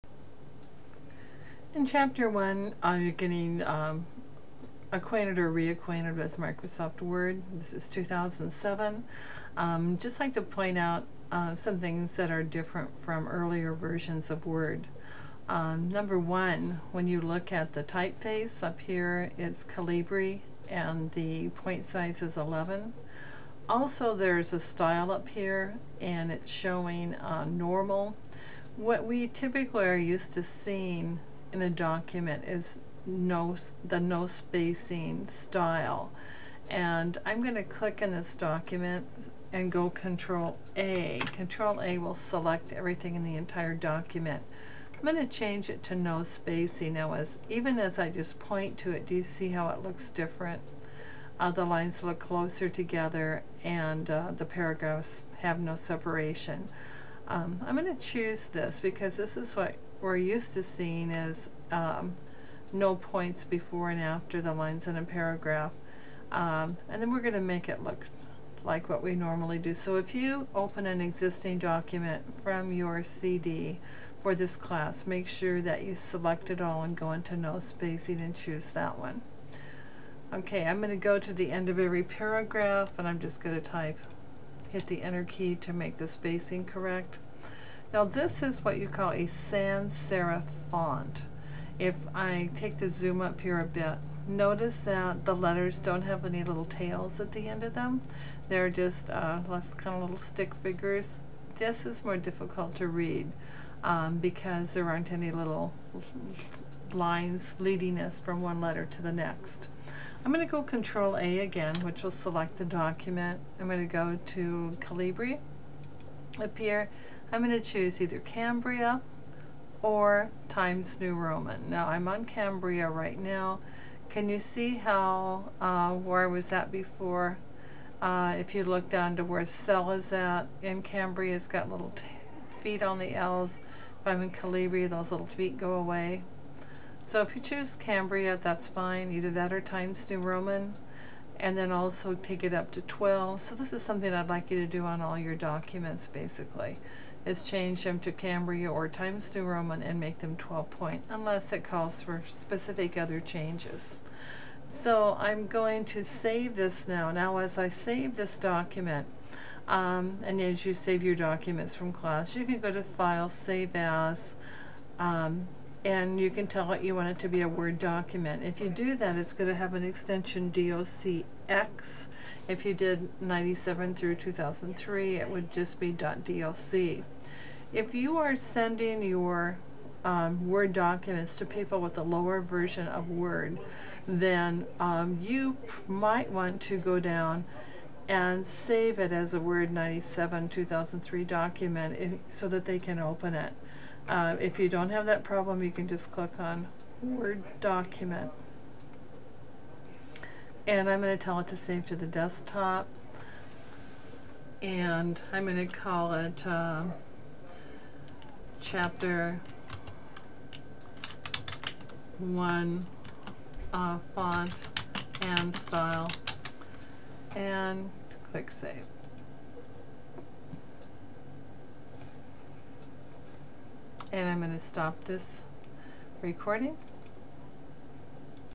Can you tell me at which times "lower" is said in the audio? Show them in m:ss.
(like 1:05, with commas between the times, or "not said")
3:02.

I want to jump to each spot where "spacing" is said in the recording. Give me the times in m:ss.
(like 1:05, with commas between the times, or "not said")
0:34, 0:46, 1:17, 1:26.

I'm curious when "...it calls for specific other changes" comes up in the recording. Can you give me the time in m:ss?
2:31.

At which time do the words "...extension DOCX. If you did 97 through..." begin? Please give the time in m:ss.
2:49.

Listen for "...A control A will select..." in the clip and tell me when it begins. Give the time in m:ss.
0:40.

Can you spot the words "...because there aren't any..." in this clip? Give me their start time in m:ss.
1:44.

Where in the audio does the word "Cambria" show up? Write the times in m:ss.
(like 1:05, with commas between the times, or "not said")
1:58, 2:02, 2:10, 2:17, 2:28.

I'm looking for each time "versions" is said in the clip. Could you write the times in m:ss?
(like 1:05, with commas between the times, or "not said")
0:13, 3:02.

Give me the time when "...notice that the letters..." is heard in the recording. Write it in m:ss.
1:34.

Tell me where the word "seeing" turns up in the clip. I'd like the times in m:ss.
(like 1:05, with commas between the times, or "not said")
0:30, 1:00.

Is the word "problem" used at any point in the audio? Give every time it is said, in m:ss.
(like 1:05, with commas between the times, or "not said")
3:15.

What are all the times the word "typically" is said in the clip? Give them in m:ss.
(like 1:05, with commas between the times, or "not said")
0:29.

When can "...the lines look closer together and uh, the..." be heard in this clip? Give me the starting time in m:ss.
0:51.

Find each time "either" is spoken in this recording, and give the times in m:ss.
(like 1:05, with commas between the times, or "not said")
1:58, 2:19.